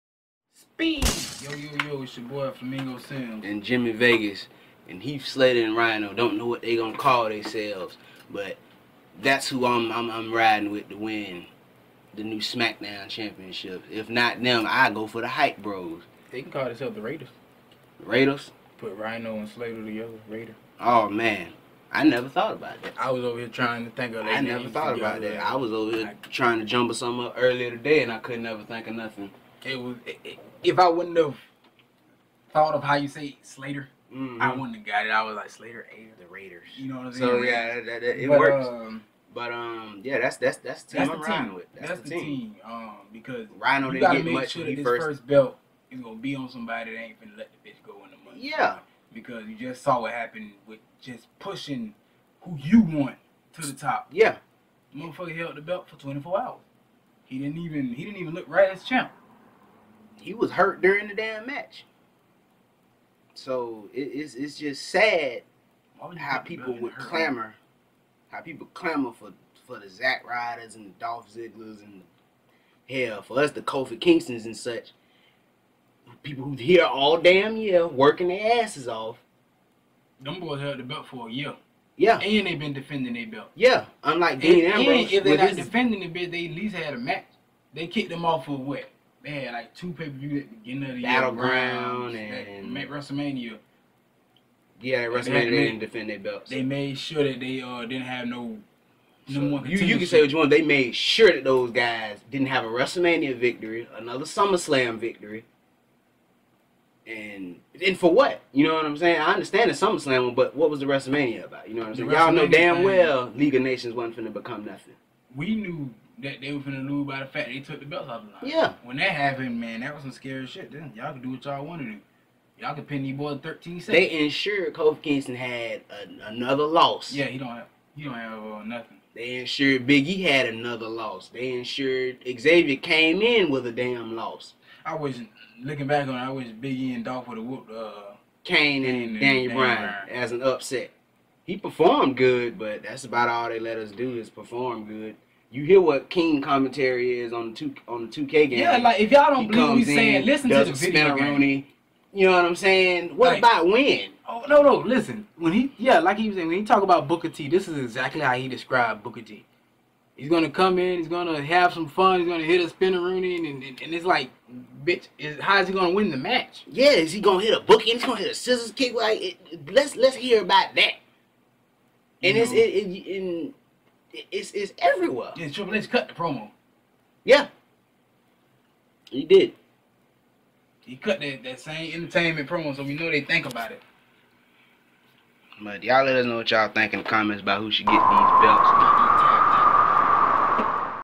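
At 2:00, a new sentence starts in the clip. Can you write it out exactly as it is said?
Then y'all could do what y'all wanted to Y'all could pin these boys 13 seconds.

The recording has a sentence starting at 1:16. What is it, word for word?
People who here all damn year working their asses off.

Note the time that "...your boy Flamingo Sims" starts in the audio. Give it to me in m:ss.
0:02.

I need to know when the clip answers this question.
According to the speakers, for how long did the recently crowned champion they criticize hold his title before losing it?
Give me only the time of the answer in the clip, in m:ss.
0:55.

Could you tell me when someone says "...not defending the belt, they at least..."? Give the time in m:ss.
1:25.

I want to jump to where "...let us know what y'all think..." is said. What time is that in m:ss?
3:06.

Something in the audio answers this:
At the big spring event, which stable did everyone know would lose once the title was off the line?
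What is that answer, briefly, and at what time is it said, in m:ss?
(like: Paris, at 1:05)
League of Nations, at 1:53.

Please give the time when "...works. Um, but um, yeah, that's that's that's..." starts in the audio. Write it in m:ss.
0:38.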